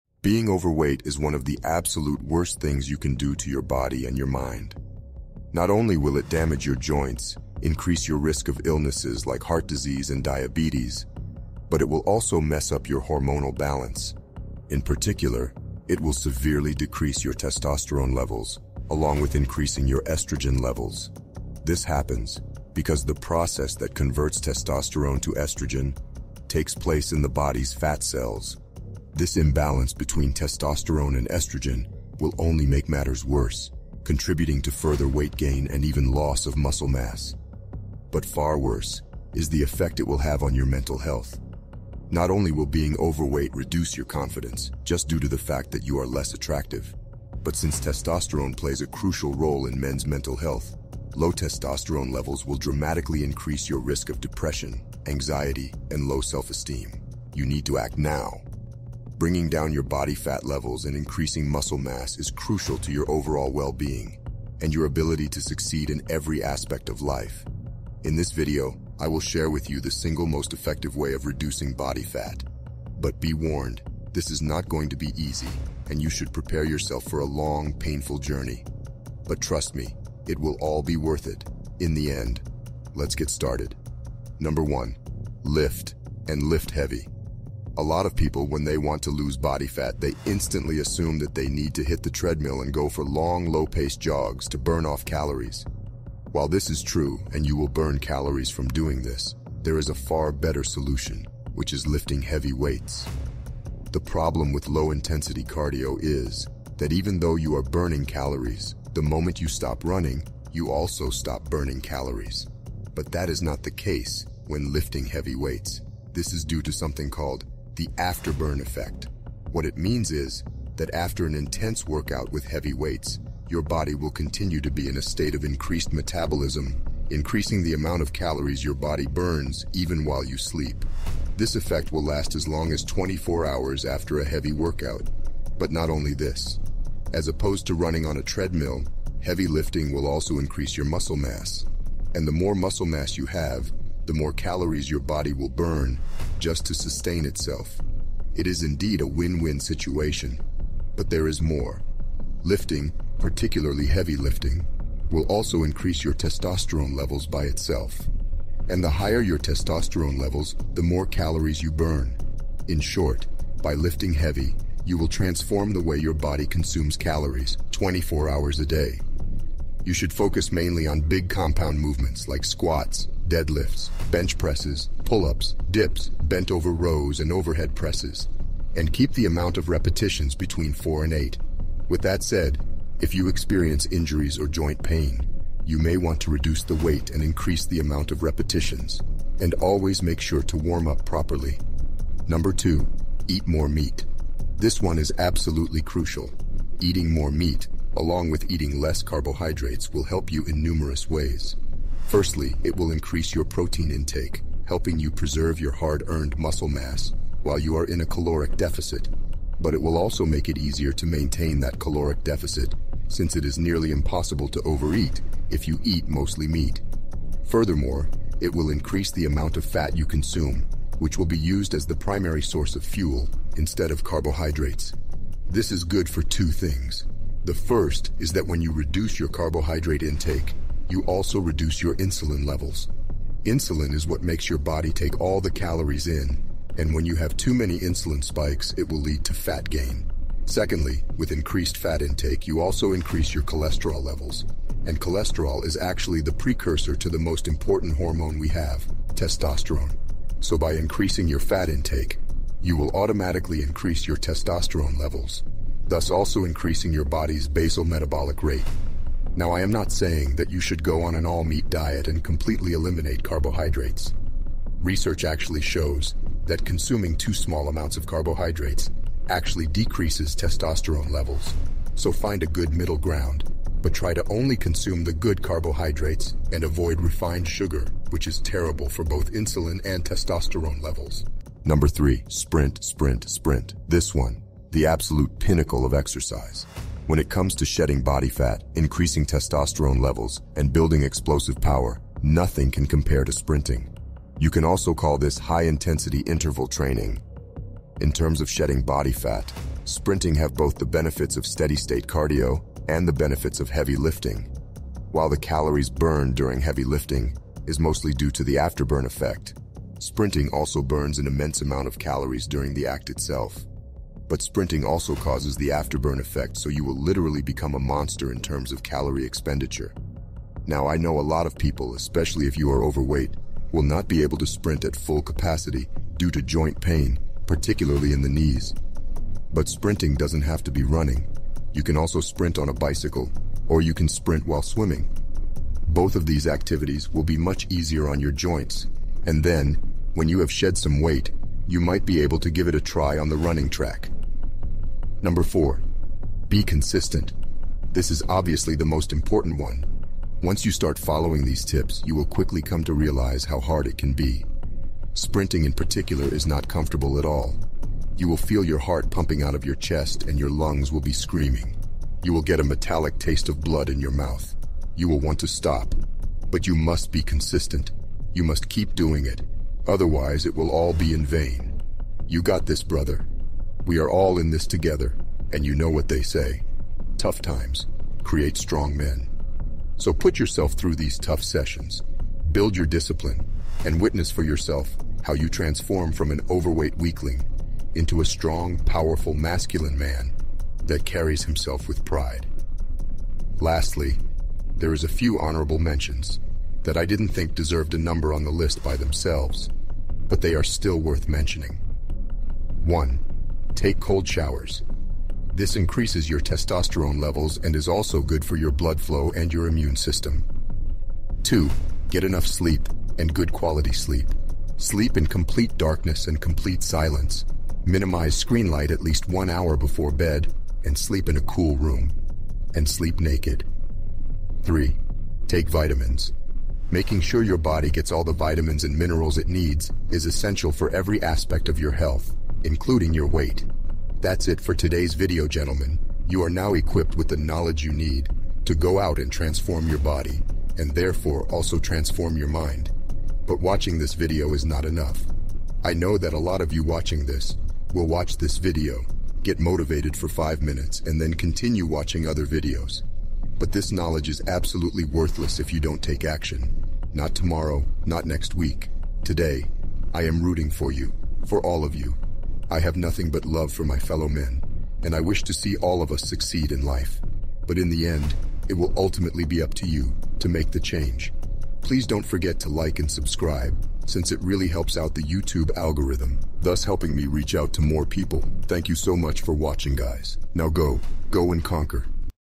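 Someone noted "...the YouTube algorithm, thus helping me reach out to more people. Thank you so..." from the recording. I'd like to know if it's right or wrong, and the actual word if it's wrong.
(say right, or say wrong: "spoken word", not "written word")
right.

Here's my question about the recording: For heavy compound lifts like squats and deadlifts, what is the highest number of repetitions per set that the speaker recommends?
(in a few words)
8.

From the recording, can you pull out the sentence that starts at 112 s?
But that is not the case when lifting heavy weights.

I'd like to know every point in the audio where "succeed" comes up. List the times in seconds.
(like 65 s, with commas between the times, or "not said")
65 s, 466 s.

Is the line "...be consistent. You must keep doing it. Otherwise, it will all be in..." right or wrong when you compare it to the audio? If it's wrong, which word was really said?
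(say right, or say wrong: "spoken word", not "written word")
right.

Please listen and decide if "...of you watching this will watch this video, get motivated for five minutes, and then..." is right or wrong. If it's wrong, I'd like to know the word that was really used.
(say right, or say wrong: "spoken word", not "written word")
right.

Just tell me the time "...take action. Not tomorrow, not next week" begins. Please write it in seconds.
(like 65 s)
456 s.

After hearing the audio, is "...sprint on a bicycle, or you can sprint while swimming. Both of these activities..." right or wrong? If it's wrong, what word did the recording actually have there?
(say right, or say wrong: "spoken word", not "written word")
right.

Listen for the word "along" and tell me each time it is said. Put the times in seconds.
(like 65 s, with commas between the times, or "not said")
18 s, 197 s.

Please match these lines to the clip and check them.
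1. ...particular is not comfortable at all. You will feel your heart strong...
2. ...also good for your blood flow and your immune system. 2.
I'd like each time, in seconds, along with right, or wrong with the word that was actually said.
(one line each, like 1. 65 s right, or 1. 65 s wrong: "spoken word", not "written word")
1. 355 s wrong: "pumping", not "strong"
2. 407 s right.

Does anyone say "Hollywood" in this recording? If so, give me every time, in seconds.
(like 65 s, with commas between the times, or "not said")
not said.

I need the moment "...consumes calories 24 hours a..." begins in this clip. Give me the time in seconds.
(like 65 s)
166 s.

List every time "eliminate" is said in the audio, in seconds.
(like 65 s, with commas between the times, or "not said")
262 s.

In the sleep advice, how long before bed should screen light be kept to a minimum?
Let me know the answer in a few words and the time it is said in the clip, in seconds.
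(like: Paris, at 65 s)
One hour, at 419 s.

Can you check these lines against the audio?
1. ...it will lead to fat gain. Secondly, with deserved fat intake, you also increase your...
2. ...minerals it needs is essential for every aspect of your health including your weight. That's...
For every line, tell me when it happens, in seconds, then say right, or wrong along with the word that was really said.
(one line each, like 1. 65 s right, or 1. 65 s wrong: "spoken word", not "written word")
1. 238 s wrong: "increased", not "deserved"
2. 428 s right.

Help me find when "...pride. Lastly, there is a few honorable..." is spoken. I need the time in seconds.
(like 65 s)
392 s.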